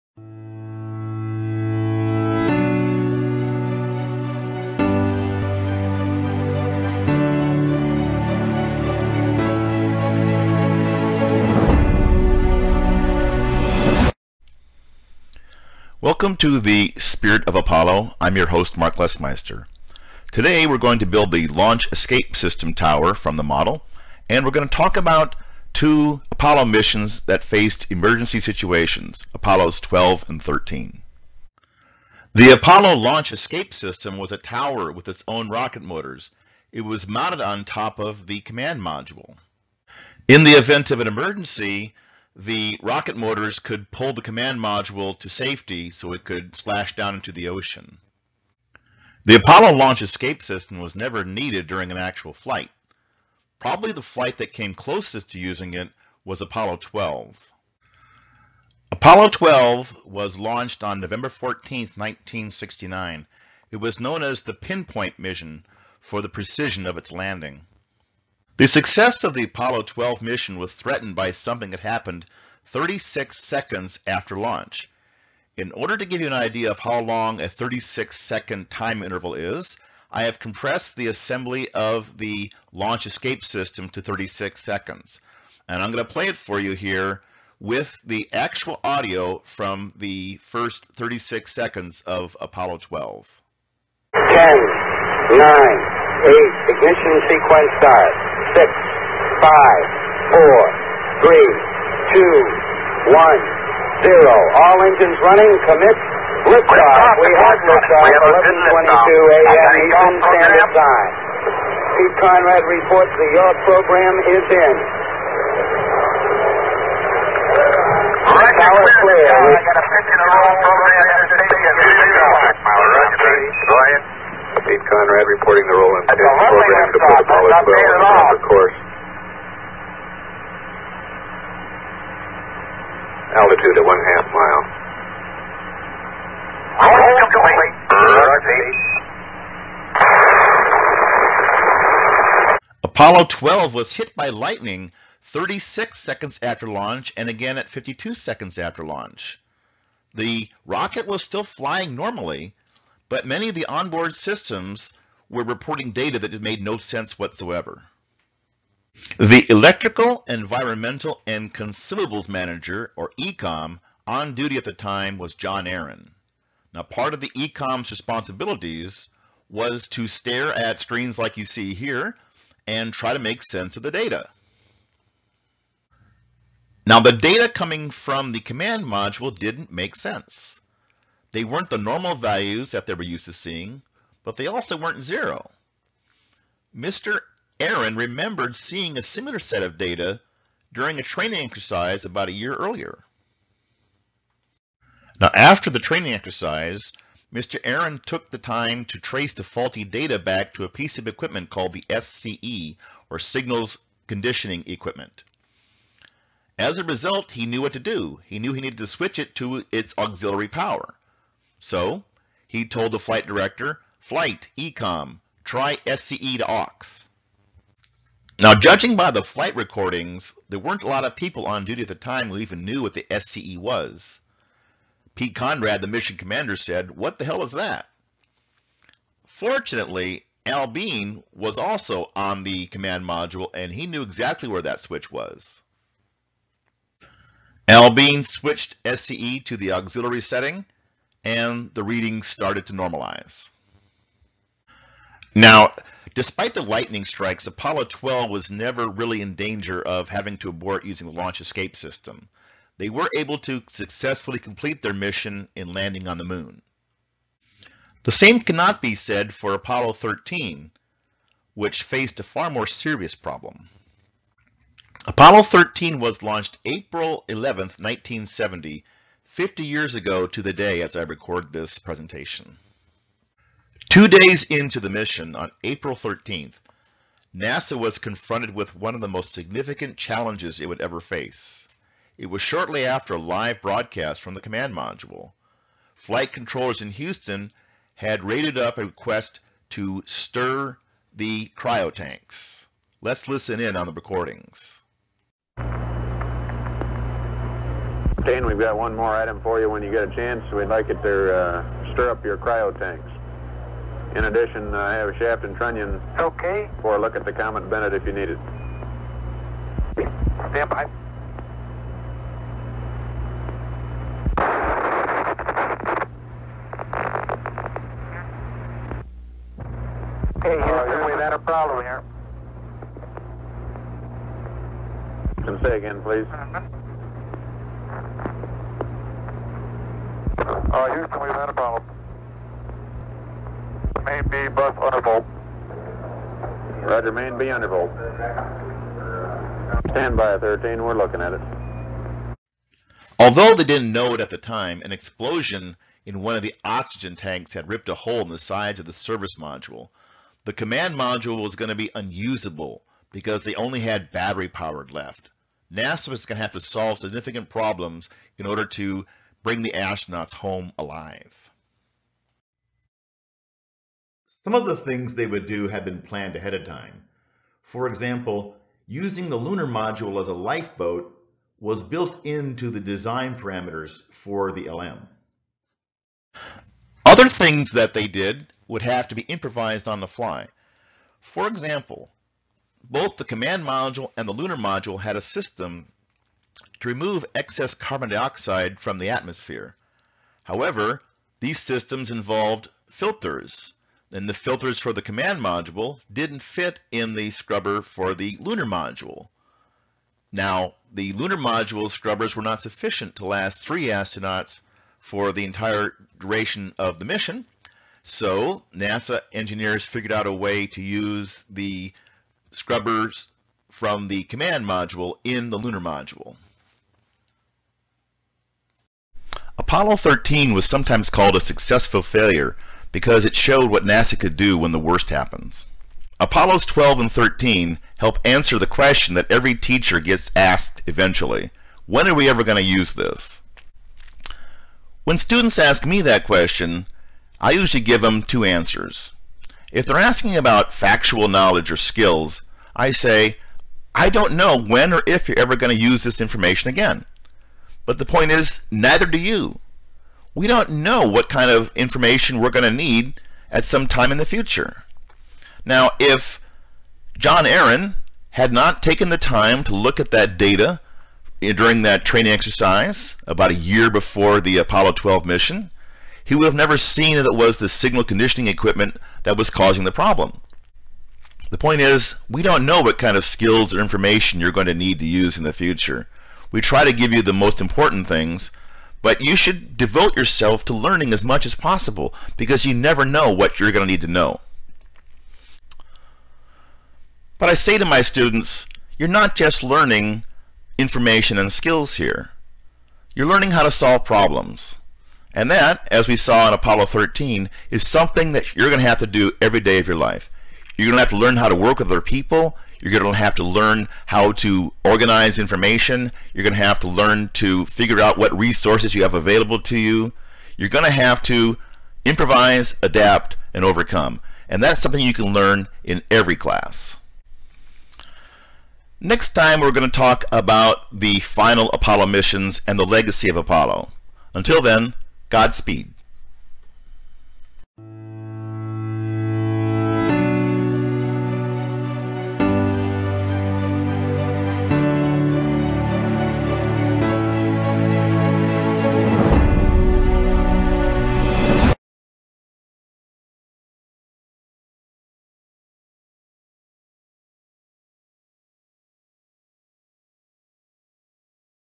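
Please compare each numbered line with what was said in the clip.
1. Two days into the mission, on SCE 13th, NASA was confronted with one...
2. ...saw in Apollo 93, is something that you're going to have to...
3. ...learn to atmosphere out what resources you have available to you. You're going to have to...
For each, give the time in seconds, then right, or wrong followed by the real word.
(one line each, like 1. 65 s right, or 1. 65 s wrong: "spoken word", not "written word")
1. 273 s wrong: "April", not "SCE"
2. 496 s wrong: "13", not "93"
3. 506 s wrong: "figure", not "atmosphere".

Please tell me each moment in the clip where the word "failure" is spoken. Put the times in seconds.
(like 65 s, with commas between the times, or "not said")
422 s.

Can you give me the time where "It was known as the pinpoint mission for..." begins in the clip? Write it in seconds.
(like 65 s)
63 s.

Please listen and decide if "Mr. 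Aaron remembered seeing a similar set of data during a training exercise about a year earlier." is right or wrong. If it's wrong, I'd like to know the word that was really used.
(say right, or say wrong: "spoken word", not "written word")
right.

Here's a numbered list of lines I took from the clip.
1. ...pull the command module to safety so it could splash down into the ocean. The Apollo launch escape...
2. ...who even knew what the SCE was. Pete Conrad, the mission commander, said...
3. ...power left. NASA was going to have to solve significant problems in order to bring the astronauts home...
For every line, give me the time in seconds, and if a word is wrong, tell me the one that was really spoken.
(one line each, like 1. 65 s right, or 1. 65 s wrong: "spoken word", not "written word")
1. 43 s right
2. 222 s right
3. 354 s right.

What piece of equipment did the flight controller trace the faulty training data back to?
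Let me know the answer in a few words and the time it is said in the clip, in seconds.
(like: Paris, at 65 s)
Signals Conditioning Equipment, at 203 s.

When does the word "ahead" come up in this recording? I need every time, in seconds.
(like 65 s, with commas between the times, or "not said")
123 s, 366 s.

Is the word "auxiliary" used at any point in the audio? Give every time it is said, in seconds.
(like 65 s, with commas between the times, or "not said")
209 s, 239 s.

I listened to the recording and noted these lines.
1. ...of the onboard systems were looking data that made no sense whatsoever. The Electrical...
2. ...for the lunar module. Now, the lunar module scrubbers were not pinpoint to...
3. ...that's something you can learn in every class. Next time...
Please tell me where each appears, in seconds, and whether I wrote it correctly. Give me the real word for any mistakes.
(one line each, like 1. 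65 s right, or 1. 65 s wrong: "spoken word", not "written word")
1. 153 s wrong: "reporting", not "looking"
2. 397 s wrong: "sufficient", not "pinpoint"
3. 514 s right.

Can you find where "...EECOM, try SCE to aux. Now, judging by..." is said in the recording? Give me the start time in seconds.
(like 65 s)
214 s.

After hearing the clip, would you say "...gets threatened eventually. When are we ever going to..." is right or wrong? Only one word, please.
wrong.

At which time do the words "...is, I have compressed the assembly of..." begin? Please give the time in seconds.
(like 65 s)
79 s.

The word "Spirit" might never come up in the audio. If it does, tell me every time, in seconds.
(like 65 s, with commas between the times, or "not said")
16 s.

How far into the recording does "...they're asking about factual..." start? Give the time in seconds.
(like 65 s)
439 s.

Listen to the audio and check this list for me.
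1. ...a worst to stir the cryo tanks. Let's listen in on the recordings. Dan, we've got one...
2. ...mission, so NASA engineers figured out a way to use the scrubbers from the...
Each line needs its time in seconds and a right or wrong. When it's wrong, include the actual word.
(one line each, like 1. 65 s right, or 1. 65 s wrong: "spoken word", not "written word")
1. 288 s wrong: "request", not "worst"
2. 407 s right.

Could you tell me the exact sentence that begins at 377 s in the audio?
Other things that they did would have to be improvised on the fly.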